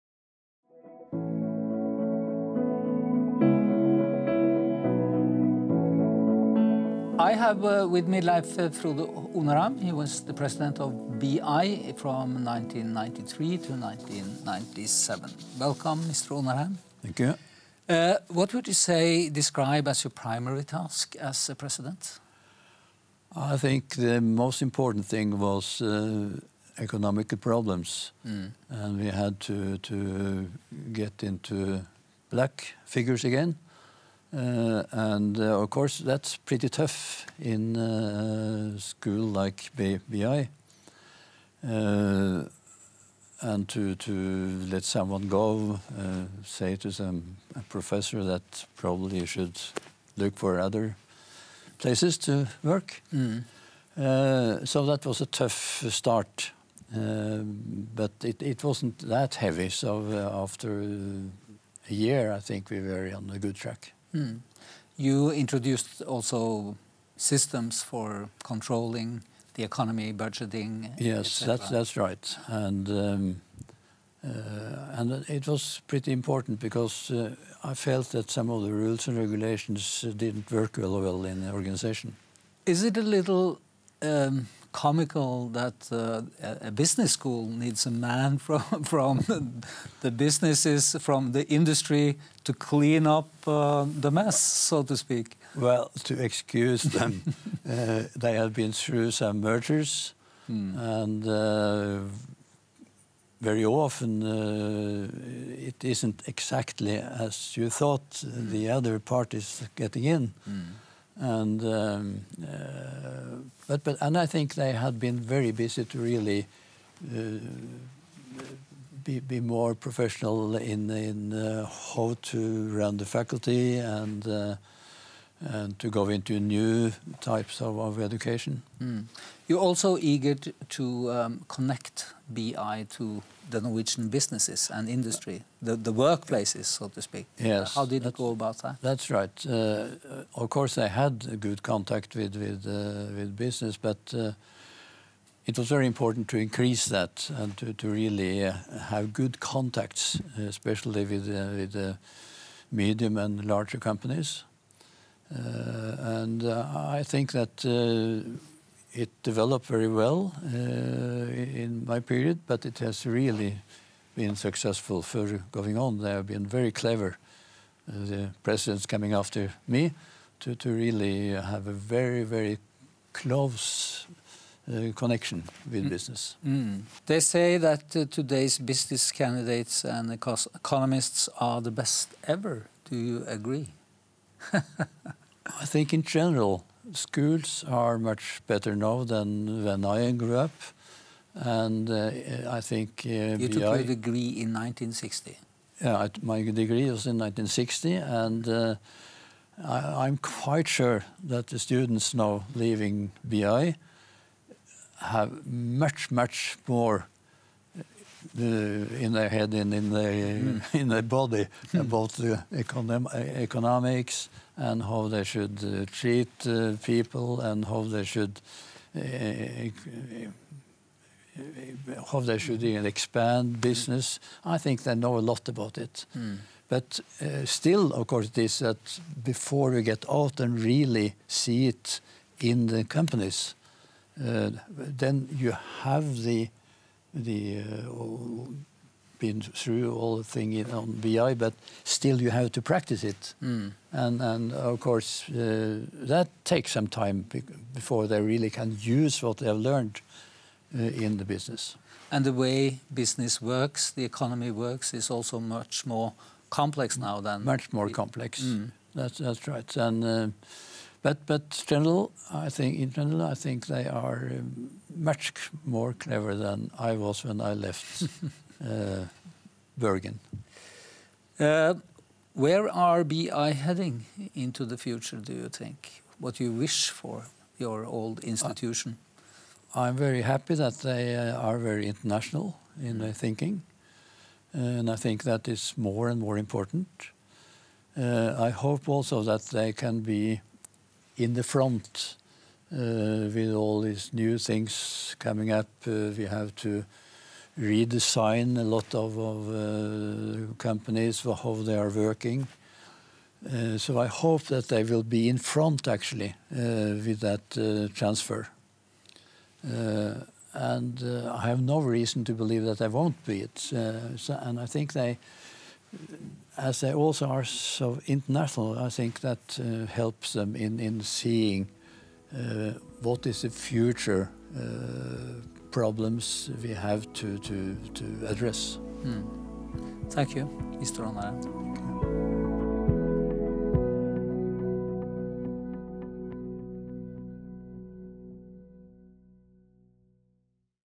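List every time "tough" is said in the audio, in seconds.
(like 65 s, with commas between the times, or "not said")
36 s, 55 s.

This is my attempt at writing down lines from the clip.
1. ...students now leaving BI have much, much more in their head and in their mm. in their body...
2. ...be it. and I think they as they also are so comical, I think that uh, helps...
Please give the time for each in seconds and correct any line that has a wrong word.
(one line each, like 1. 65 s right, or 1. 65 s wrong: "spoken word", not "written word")
1. 201 s right
2. 313 s wrong: "international", not "comical".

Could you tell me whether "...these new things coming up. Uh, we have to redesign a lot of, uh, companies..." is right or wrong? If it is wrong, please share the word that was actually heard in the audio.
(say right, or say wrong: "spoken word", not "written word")
right.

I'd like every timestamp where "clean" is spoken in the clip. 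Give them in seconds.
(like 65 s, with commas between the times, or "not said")
92 s.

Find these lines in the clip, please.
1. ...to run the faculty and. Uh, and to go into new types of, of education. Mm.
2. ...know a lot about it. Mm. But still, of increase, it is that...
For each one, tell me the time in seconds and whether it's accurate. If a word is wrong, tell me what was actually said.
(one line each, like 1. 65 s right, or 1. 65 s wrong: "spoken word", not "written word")
1. 122 s right
2. 224 s wrong: "course", not "increase".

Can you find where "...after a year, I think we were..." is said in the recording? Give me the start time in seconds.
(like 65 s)
60 s.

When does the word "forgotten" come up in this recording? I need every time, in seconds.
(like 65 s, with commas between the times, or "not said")
not said.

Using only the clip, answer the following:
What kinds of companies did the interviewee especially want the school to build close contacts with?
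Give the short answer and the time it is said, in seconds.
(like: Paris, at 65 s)
Medium and larger companies, at 152 s.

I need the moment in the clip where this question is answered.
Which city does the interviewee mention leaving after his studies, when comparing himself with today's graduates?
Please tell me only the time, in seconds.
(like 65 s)
269 s.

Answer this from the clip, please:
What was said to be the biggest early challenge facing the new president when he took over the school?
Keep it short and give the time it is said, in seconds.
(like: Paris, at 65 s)
Economic problems, at 26 s.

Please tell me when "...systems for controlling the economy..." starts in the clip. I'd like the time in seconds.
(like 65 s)
67 s.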